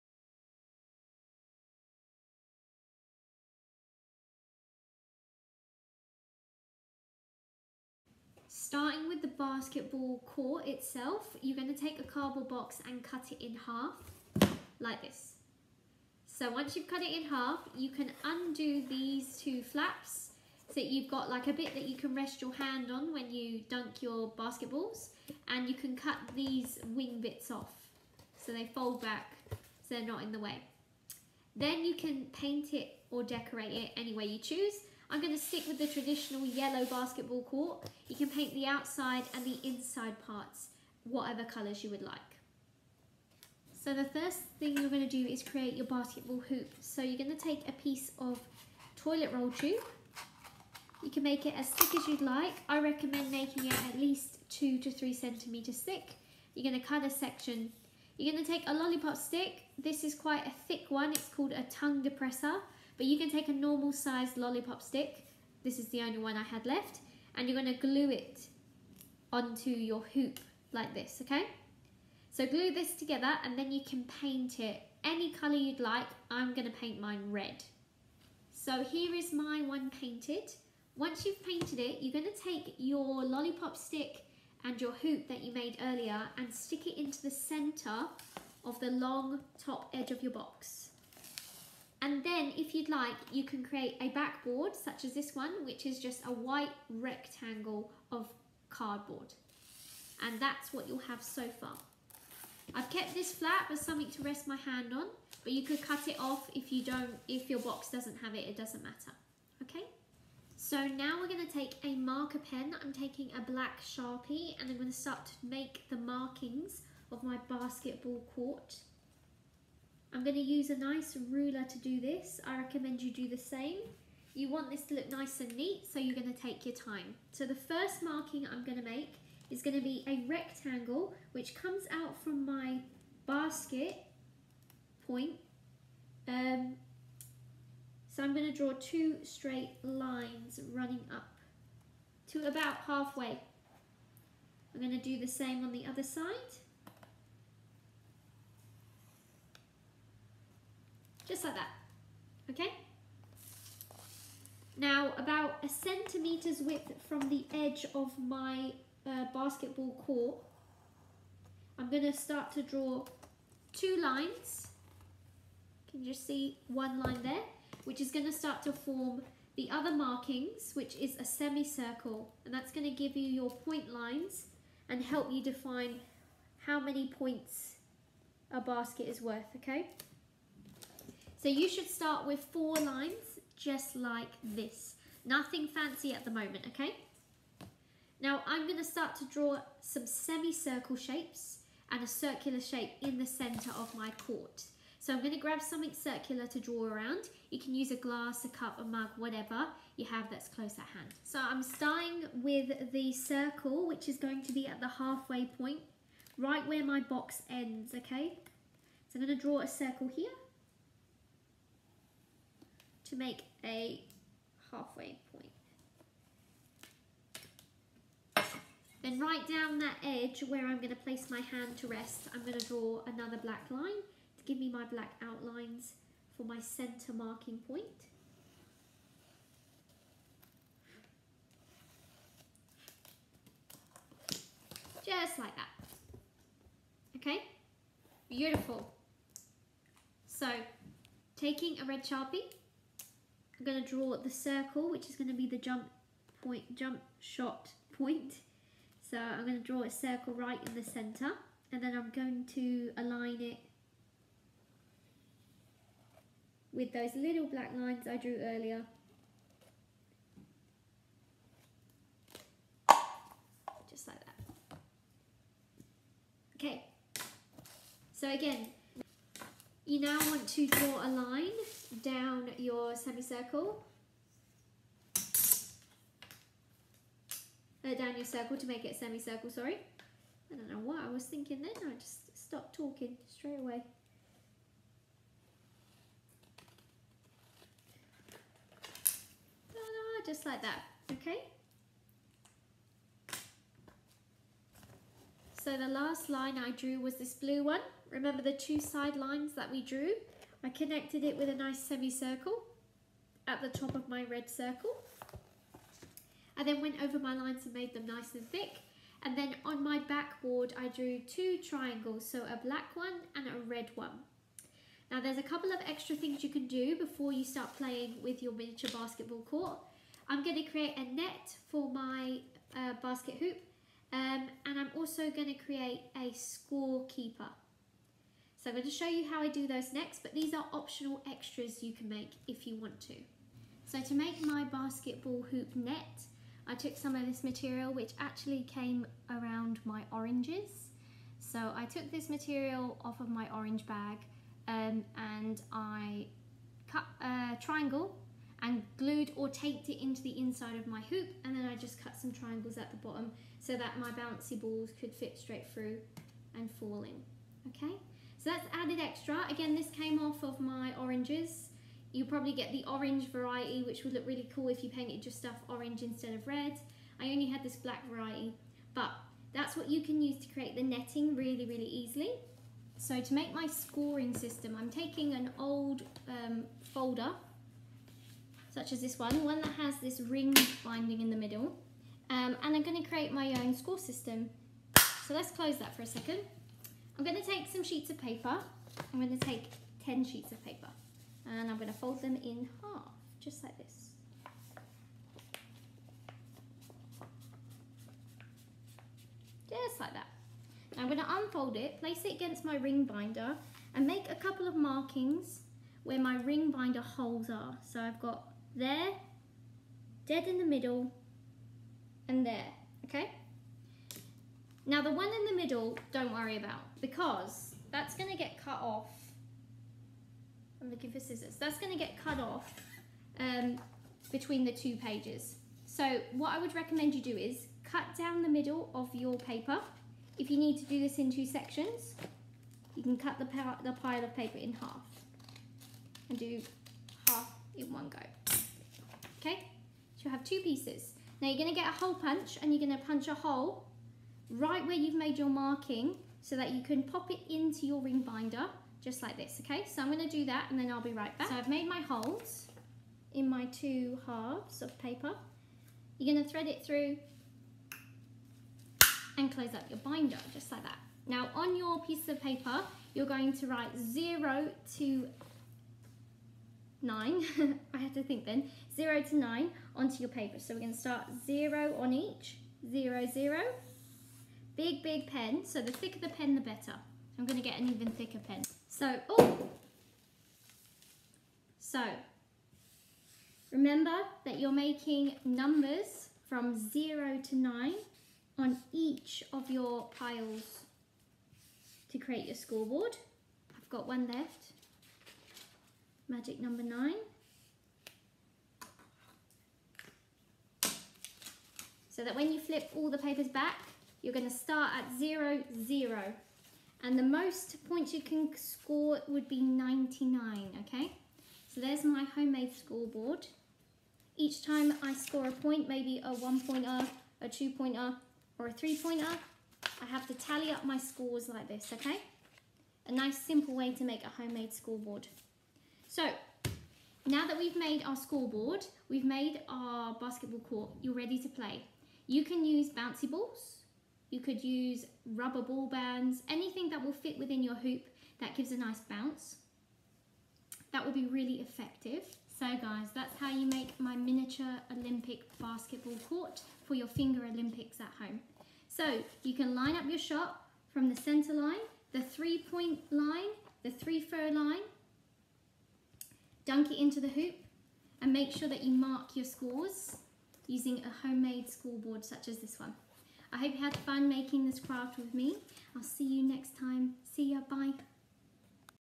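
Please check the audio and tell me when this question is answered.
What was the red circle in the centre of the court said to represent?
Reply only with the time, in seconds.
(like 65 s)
245 s.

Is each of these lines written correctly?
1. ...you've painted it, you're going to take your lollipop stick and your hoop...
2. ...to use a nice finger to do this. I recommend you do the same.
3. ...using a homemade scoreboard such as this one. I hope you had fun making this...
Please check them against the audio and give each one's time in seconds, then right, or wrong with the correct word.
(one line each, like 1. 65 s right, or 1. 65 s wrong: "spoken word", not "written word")
1. 81 s right
2. 120 s wrong: "ruler", not "finger"
3. 560 s right.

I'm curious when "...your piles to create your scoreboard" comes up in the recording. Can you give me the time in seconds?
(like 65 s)
489 s.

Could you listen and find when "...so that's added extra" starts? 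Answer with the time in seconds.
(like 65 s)
358 s.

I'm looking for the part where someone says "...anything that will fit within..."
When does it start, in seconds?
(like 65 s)
536 s.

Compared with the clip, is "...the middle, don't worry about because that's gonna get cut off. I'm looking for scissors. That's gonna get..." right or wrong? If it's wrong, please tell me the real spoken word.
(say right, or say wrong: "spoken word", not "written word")
right.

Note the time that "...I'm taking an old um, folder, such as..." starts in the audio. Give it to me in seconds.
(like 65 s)
374 s.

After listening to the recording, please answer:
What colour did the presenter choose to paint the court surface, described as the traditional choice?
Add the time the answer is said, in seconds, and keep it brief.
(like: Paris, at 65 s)
yellow, at 36 s.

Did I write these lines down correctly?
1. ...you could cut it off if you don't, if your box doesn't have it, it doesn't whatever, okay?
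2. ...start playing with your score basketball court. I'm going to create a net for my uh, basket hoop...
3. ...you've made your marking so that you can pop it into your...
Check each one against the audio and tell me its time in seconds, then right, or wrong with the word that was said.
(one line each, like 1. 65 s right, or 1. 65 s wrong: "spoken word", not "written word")
1. 105 s wrong: "matter", not "whatever"
2. 317 s wrong: "miniature", not "score"
3. 444 s right.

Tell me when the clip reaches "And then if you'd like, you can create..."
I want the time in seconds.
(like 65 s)
92 s.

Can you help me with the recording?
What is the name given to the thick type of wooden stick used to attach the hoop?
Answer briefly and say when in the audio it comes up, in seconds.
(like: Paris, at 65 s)
tongue depressor, at 61 s.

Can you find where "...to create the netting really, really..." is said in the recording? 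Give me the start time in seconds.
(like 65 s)
370 s.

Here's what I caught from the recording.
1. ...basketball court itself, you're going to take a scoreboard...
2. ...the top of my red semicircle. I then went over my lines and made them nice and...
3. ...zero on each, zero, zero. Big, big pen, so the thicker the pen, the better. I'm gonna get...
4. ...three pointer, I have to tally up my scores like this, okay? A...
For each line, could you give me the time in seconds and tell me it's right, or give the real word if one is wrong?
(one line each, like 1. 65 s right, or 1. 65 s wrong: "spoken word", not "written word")
1. 9 s wrong: "cardboard", not "scoreboard"
2. 303 s wrong: "circle", not "semicircle"
3. 471 s right
4. 518 s right.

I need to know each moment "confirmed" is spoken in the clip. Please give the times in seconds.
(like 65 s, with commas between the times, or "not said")
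not said.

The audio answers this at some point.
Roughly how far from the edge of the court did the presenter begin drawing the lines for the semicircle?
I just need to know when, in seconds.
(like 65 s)
155 s.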